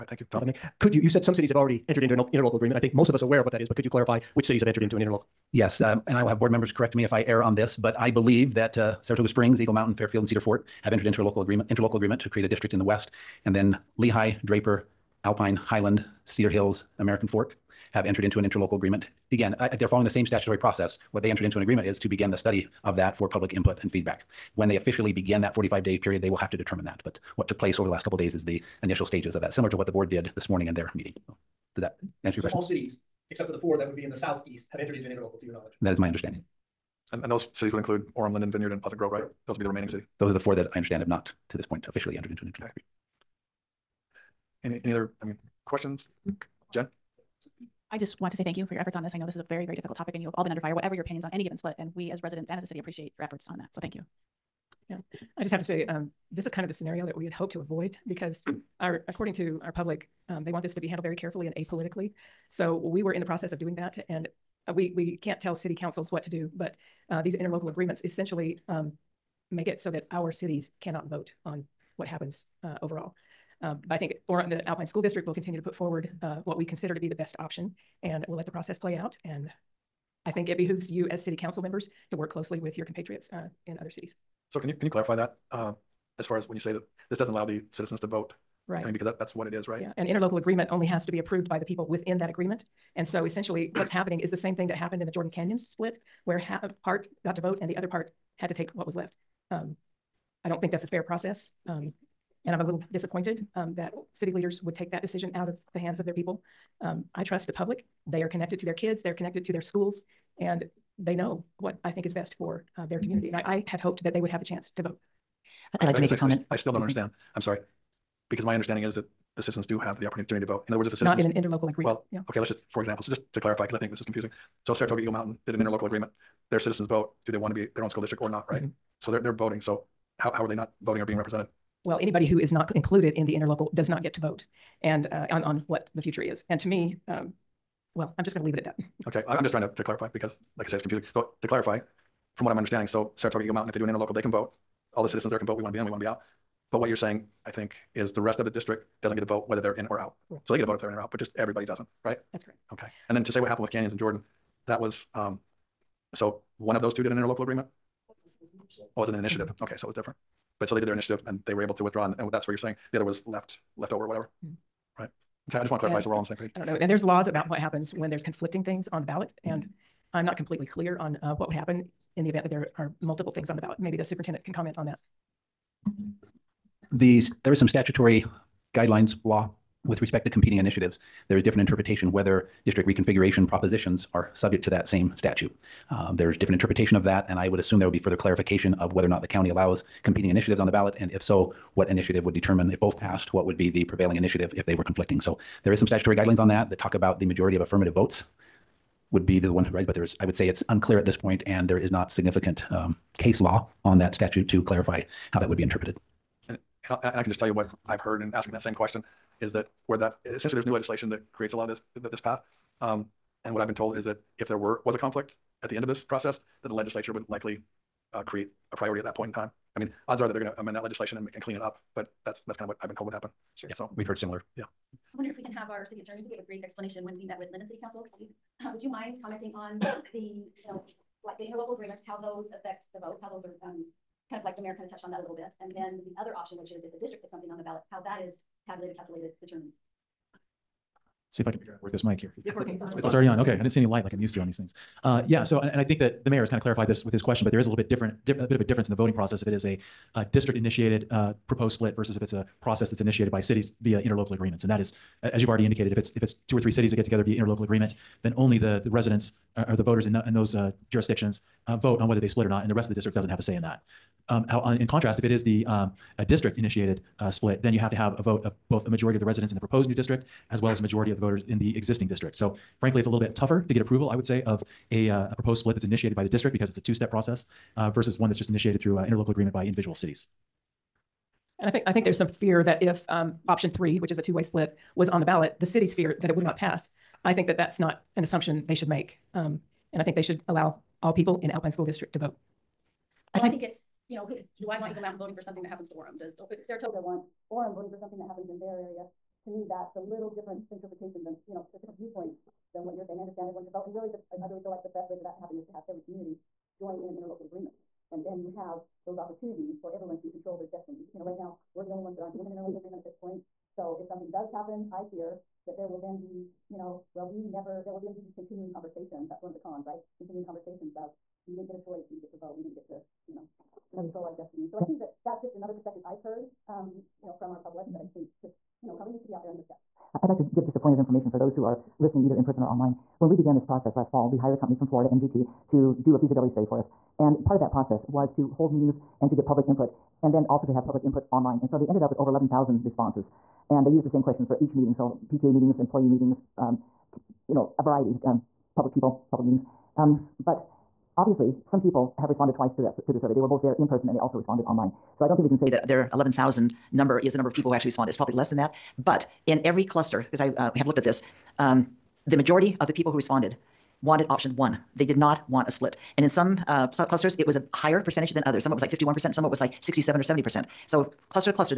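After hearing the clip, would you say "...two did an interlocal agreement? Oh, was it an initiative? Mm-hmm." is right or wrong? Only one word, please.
right.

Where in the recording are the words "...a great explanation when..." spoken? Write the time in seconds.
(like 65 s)
226 s.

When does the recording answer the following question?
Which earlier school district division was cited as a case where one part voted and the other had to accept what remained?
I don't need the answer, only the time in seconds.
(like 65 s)
95 s.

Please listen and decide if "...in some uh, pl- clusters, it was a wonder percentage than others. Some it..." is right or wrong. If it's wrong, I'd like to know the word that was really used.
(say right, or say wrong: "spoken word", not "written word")
wrong: "higher", not "wonder".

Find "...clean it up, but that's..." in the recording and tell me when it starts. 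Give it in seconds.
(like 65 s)
221 s.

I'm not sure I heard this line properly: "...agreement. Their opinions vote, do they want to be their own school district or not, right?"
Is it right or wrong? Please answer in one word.
wrong.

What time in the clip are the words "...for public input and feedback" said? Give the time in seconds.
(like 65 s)
23 s.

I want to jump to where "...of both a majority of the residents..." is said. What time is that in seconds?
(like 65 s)
268 s.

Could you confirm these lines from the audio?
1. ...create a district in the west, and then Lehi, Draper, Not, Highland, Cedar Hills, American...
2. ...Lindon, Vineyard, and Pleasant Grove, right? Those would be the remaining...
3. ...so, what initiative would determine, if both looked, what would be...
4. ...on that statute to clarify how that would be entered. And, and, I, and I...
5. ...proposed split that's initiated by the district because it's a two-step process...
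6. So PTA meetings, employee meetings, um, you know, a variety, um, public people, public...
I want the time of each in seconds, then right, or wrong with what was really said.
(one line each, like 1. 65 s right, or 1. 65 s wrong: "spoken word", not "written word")
1. 12 s wrong: "Alpine", not "Not"
2. 38 s right
3. 191 s wrong: "passed", not "looked"
4. 203 s wrong: "interpreted", not "entered"
5. 275 s right
6. 344 s right.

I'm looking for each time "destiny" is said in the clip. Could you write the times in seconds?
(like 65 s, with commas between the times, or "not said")
310 s, 324 s.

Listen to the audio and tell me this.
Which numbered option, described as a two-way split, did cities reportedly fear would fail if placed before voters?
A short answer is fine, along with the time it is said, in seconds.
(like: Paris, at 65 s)
Option 3, at 283 s.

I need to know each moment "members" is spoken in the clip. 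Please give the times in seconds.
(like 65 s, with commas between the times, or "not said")
6 s, 81 s.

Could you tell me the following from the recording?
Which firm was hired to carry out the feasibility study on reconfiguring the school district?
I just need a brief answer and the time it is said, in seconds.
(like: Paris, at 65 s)
MGT, at 335 s.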